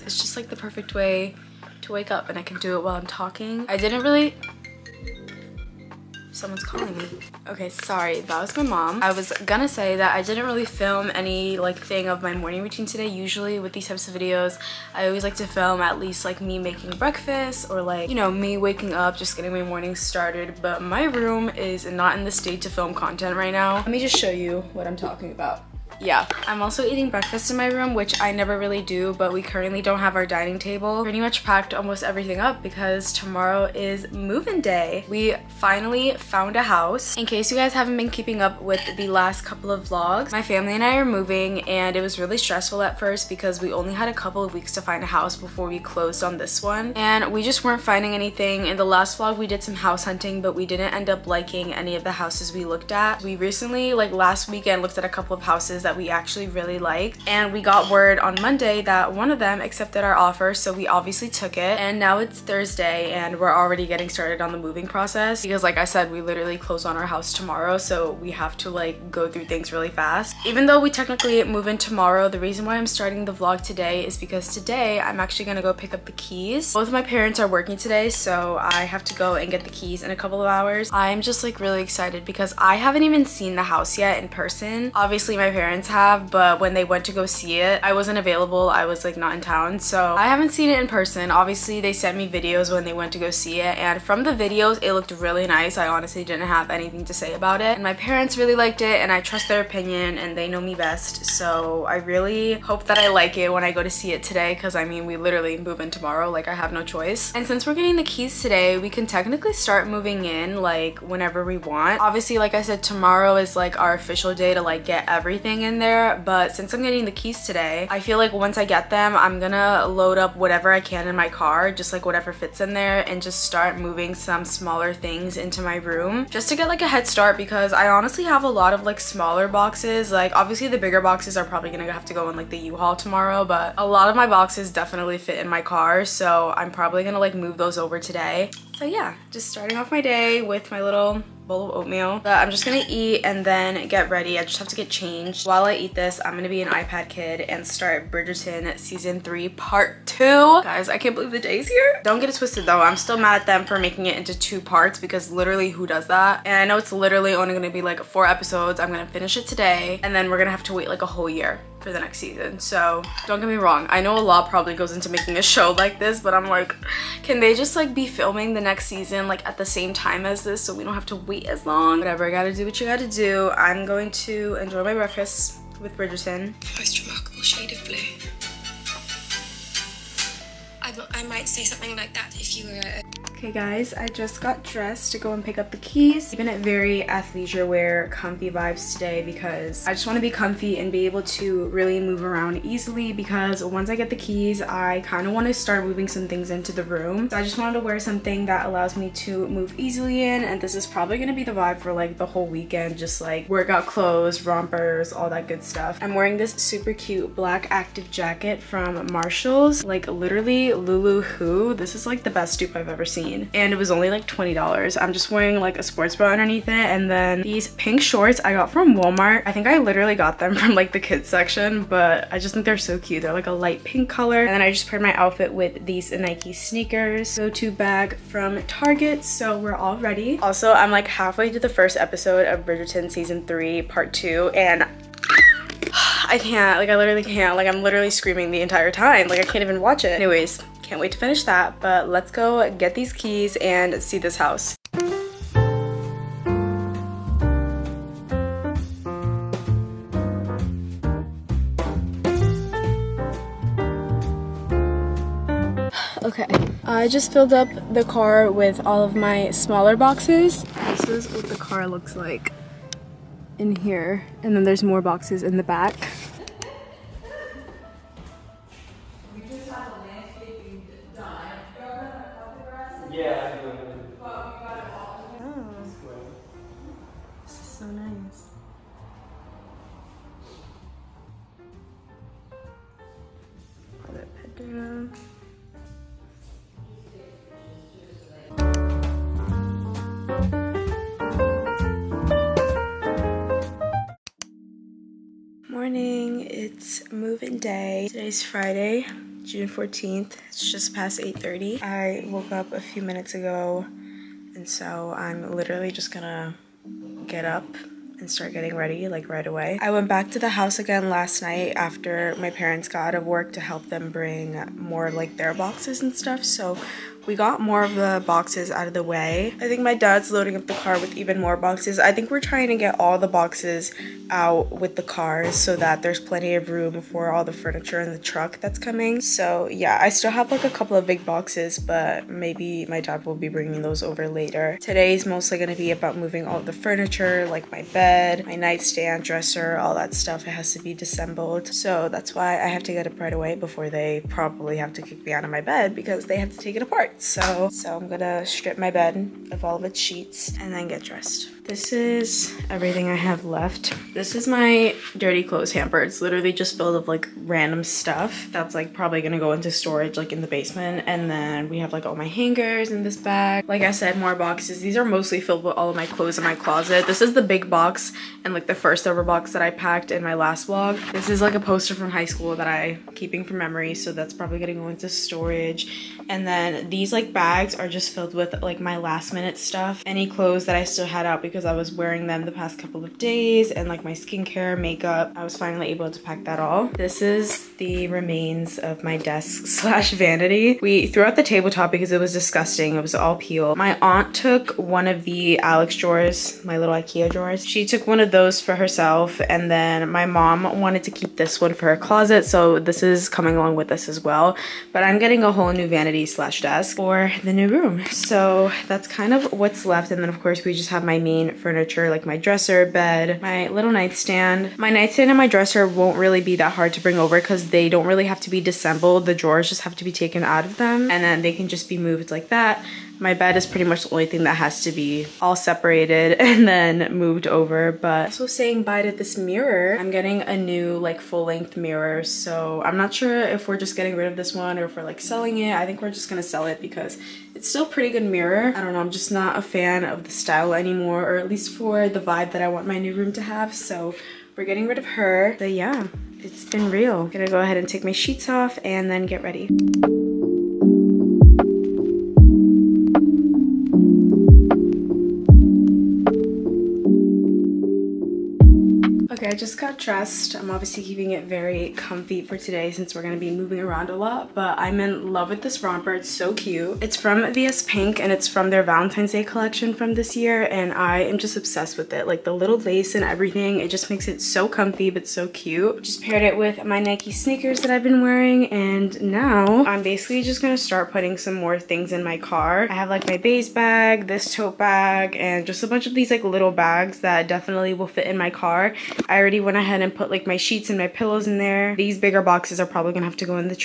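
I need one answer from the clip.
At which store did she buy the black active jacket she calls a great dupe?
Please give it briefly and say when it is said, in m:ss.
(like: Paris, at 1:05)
Marshalls, at 3:29.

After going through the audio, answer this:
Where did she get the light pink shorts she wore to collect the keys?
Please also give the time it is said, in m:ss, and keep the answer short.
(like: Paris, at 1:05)
Walmart, at 3:38.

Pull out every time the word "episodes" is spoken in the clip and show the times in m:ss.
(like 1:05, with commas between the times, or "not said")
2:38, 3:51.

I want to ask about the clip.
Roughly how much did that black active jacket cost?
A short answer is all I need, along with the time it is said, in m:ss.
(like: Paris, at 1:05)
$20, at 3:34.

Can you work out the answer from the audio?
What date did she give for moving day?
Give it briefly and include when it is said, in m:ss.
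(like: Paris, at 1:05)
Friday, June 14th, at 4:58.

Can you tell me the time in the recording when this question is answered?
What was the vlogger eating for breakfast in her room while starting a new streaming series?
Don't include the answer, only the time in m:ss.
2:21.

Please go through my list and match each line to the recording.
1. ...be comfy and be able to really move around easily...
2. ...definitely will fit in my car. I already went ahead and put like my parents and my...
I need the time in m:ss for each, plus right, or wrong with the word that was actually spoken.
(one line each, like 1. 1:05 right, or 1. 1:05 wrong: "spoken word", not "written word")
1. 3:10 right
2. 8:07 wrong: "sheets", not "parents".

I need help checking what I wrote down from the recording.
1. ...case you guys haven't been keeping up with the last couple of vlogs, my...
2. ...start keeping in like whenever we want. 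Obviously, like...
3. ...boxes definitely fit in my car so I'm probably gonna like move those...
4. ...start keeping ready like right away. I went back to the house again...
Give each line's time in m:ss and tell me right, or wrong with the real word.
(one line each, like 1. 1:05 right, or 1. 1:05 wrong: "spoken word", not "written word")
1. 0:37 right
2. 1:49 wrong: "moving", not "keeping"
3. 2:14 right
4. 5:08 wrong: "getting", not "keeping".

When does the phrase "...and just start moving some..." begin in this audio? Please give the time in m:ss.
2:03.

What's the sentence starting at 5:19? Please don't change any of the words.
I think my dad's loading up the car with even more boxes.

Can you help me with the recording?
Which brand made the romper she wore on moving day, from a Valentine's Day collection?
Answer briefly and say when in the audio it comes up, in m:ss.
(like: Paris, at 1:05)
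VS Pink, at 7:47.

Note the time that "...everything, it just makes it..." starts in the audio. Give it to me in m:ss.
7:53.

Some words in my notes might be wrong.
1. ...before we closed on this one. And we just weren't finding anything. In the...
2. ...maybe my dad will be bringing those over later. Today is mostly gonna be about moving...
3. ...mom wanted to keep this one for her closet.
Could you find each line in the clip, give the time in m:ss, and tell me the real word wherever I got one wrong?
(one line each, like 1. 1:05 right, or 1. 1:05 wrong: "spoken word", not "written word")
1. 0:45 right
2. 5:32 right
3. 6:40 right.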